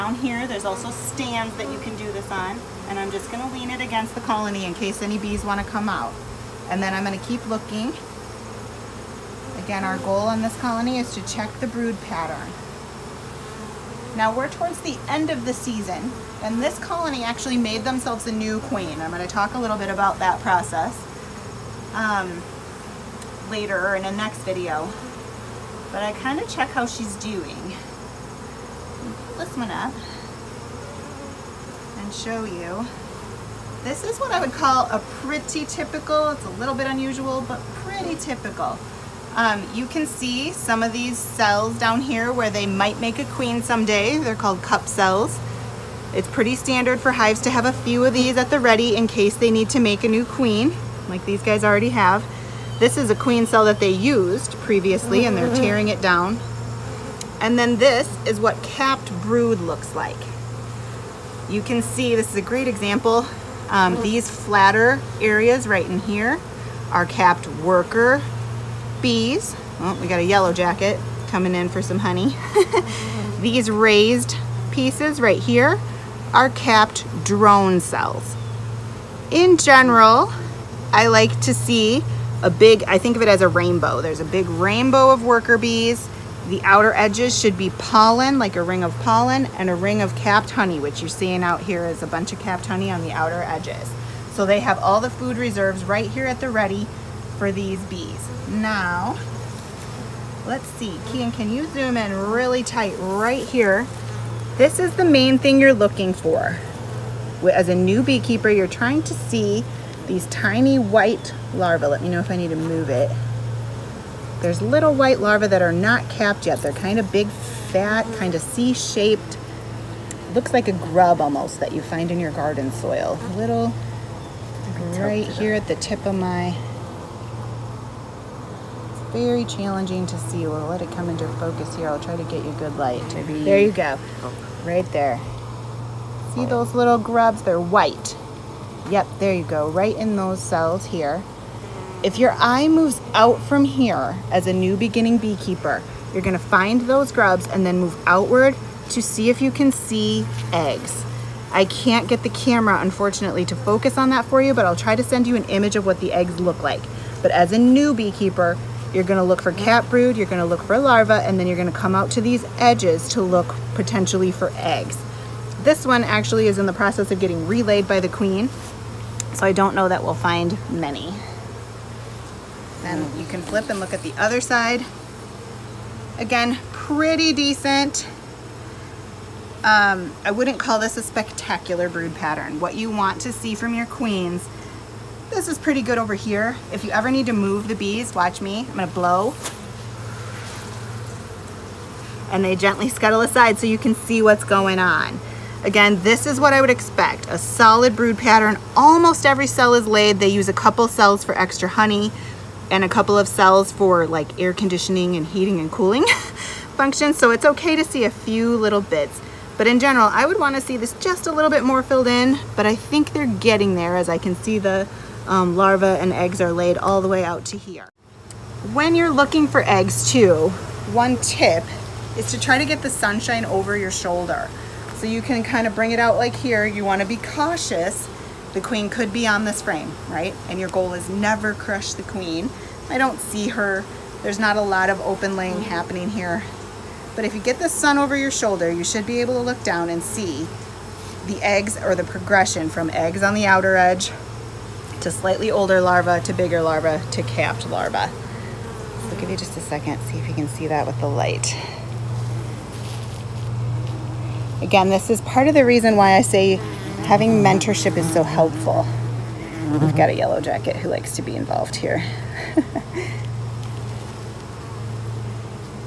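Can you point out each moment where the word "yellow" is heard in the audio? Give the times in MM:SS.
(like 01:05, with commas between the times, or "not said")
01:10, 04:20.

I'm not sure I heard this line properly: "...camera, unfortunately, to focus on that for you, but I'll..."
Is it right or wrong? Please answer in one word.
right.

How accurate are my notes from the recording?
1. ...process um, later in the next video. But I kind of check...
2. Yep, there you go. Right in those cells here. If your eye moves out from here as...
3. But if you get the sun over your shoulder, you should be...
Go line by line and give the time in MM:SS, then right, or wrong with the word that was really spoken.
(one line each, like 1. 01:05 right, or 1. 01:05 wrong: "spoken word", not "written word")
1. 00:20 right
2. 02:18 right
3. 03:57 right.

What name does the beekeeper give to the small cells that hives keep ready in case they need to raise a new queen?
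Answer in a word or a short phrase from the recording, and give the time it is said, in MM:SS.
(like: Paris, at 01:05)
Cup cells, at 00:44.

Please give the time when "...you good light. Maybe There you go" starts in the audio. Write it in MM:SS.
02:12.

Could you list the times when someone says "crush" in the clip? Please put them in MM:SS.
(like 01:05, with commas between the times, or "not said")
03:51.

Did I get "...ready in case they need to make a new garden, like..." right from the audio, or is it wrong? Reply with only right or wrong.
wrong.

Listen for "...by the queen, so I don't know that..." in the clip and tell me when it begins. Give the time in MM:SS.
02:47.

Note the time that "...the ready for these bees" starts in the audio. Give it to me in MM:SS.
01:36.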